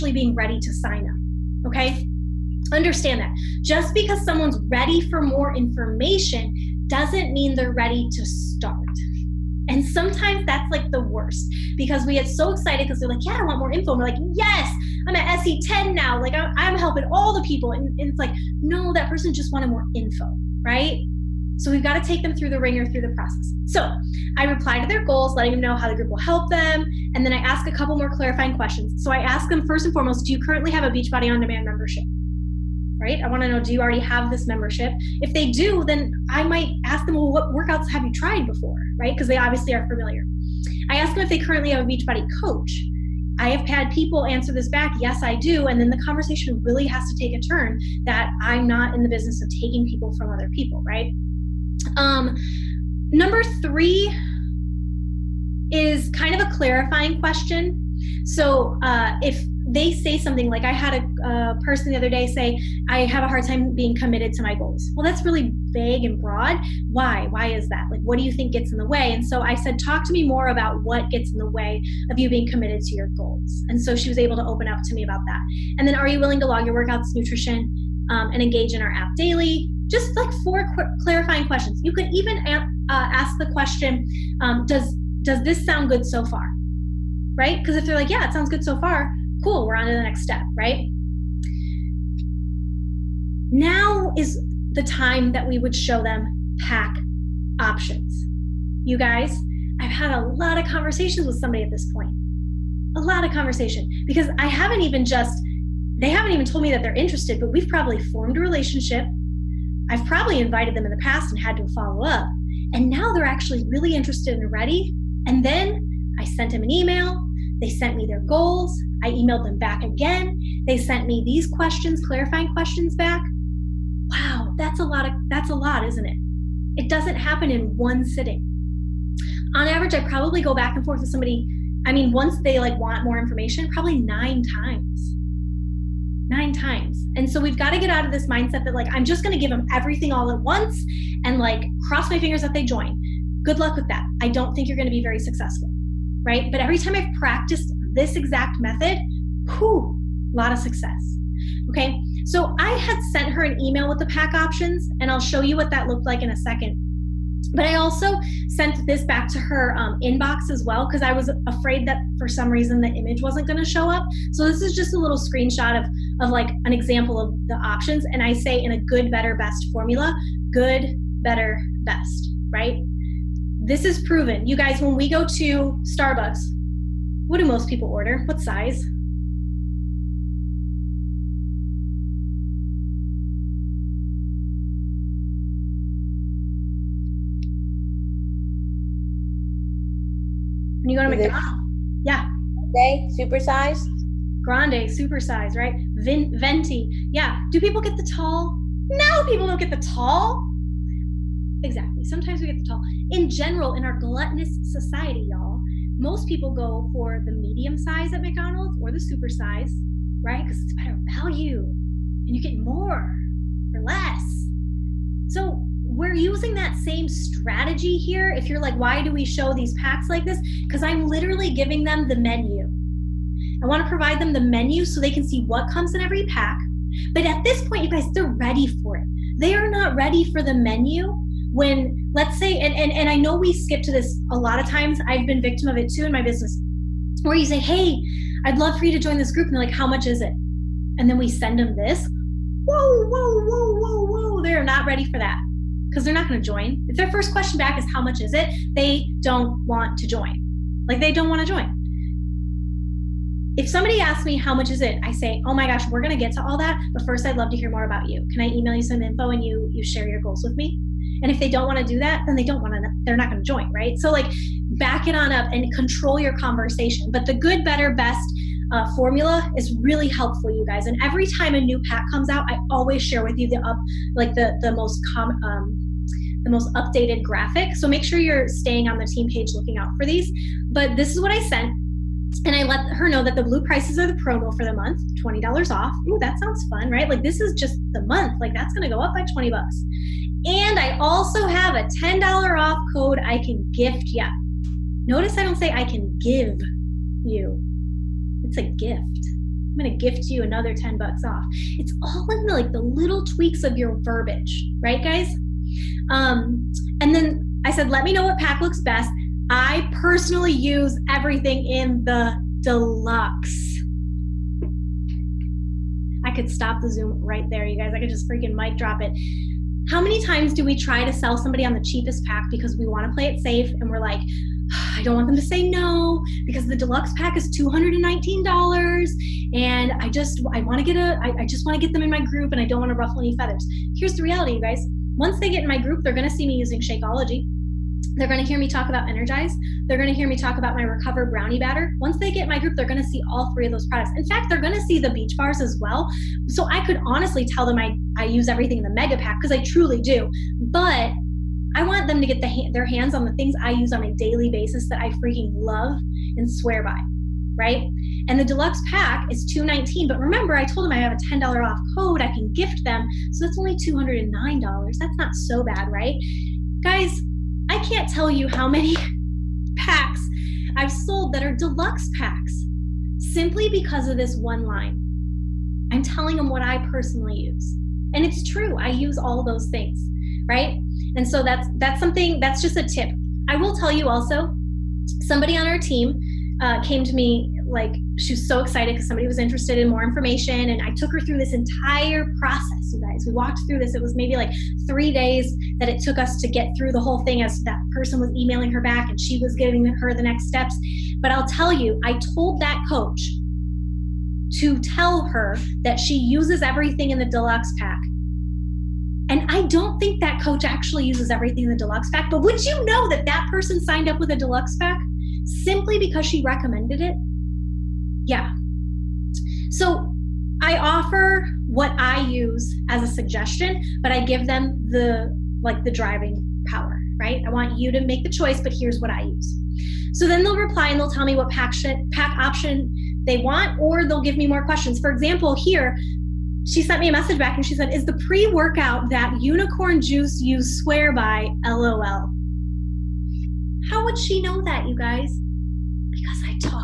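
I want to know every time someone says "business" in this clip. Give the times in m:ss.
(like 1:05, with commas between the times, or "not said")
0:49, 3:56.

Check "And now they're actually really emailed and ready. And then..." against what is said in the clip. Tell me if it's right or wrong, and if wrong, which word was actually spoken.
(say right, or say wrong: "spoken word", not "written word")
wrong: "interested", not "emailed".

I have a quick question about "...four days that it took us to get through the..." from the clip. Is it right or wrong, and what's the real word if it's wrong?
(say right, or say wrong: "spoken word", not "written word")
wrong: "three", not "four".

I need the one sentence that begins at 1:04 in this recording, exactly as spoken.
Well, that's really vague and broad.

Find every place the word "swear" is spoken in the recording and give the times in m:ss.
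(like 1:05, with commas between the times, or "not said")
5:56, 7:20.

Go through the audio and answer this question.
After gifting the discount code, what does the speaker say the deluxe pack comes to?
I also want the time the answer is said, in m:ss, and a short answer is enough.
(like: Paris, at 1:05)
$209, at 6:03.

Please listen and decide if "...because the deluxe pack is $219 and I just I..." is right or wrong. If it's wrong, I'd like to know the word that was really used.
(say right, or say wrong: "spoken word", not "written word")
right.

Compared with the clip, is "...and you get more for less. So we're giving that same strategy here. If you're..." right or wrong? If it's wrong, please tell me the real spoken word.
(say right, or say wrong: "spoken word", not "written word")
wrong: "using", not "giving".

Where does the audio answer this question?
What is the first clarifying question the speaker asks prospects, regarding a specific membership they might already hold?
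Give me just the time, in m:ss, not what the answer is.
0:30.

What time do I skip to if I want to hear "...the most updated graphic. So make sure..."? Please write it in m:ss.
4:36.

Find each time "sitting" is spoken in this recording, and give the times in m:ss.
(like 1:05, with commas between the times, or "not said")
2:08.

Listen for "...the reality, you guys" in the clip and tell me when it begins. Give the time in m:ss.
5:34.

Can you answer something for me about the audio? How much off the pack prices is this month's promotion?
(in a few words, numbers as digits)
$20.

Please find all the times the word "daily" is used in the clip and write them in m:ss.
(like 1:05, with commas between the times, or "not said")
1:19, 5:54.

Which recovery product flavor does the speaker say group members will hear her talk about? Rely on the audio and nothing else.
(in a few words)
Recover Brownie Batter.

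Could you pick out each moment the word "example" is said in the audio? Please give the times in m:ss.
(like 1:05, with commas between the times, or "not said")
2:46, 7:15.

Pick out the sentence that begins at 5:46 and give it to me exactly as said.
So I could honestly tell them I, I use everything in the mega pack because I truly do.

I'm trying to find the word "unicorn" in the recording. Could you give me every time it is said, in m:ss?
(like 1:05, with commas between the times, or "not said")
7:19.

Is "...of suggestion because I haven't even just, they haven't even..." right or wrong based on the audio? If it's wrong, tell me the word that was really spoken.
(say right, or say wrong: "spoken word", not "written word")
wrong: "conversation", not "suggestion".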